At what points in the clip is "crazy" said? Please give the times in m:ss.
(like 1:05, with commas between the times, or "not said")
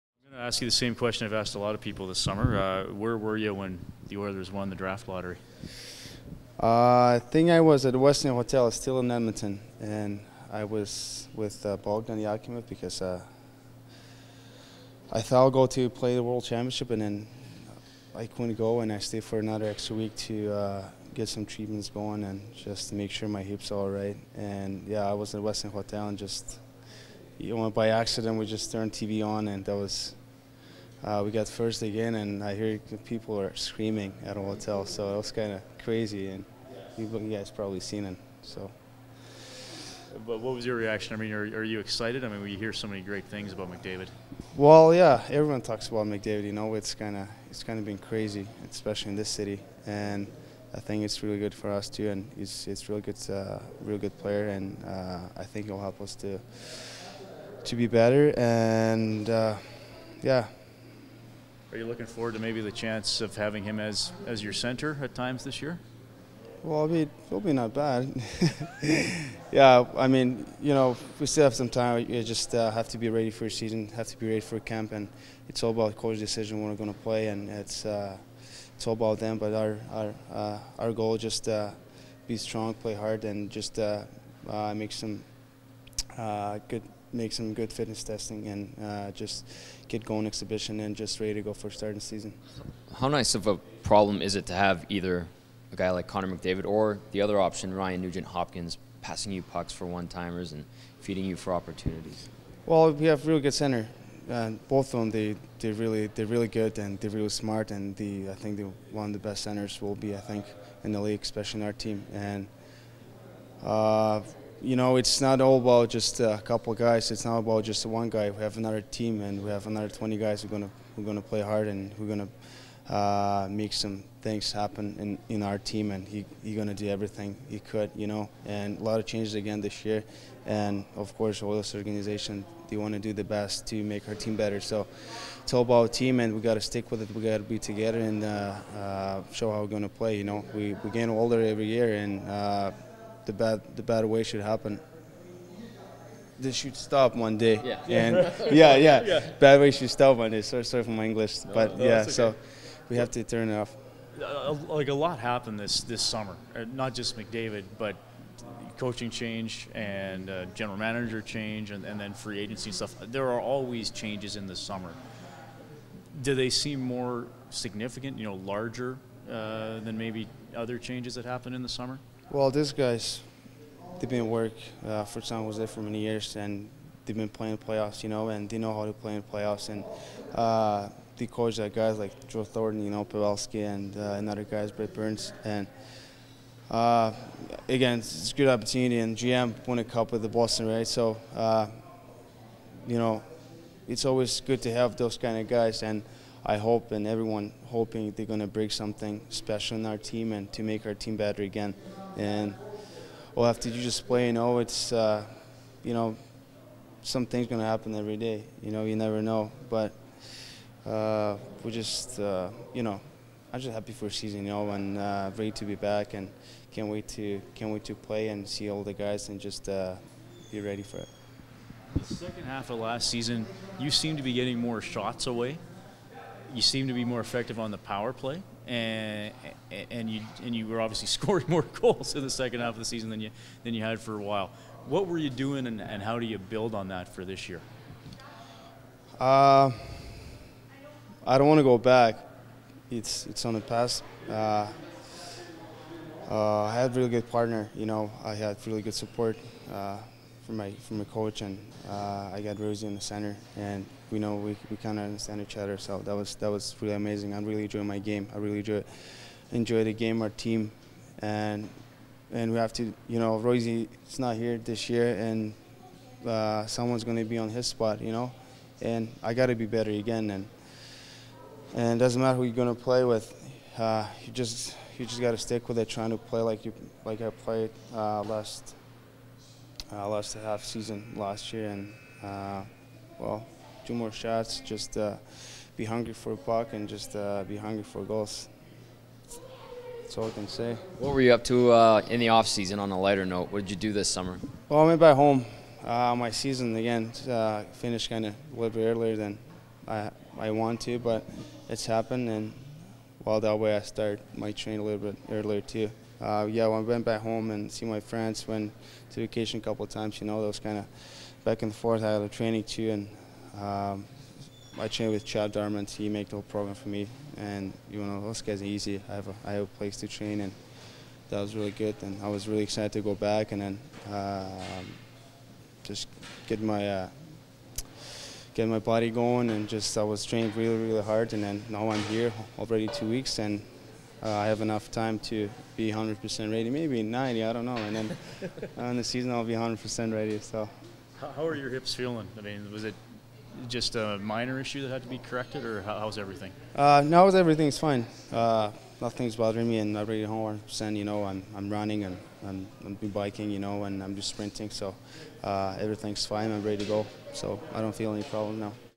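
0:35, 0:47.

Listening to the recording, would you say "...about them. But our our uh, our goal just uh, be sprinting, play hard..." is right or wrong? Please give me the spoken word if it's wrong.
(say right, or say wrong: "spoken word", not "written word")
wrong: "strong", not "sprinting".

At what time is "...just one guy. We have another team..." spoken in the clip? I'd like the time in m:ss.
1:57.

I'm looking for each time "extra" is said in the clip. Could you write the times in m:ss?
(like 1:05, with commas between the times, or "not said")
0:19.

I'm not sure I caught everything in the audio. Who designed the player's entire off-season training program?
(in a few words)
Chad Darman.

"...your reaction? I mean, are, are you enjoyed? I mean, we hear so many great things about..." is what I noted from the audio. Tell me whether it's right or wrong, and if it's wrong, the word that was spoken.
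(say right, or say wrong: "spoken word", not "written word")
wrong: "excited", not "enjoyed".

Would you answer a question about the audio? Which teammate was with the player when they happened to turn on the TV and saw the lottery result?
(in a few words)
Bogdan Yakimov.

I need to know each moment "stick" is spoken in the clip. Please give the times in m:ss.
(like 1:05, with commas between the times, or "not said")
2:16, 4:35.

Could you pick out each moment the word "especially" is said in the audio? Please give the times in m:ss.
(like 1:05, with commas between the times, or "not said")
0:48, 1:51.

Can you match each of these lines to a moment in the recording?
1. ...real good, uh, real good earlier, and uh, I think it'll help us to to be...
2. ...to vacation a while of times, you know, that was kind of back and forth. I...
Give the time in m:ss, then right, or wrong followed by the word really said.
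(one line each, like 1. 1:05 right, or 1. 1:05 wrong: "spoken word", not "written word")
1. 0:52 wrong: "player", not "earlier"
2. 5:09 wrong: "couple", not "while".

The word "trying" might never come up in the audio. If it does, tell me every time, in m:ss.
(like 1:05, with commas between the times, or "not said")
4:35.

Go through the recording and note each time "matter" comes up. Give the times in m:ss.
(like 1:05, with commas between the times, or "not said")
4:32.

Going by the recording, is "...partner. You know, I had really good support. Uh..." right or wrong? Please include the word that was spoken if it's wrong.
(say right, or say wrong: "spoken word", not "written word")
right.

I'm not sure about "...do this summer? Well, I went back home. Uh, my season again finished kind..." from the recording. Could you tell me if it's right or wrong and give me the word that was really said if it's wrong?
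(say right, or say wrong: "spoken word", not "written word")
right.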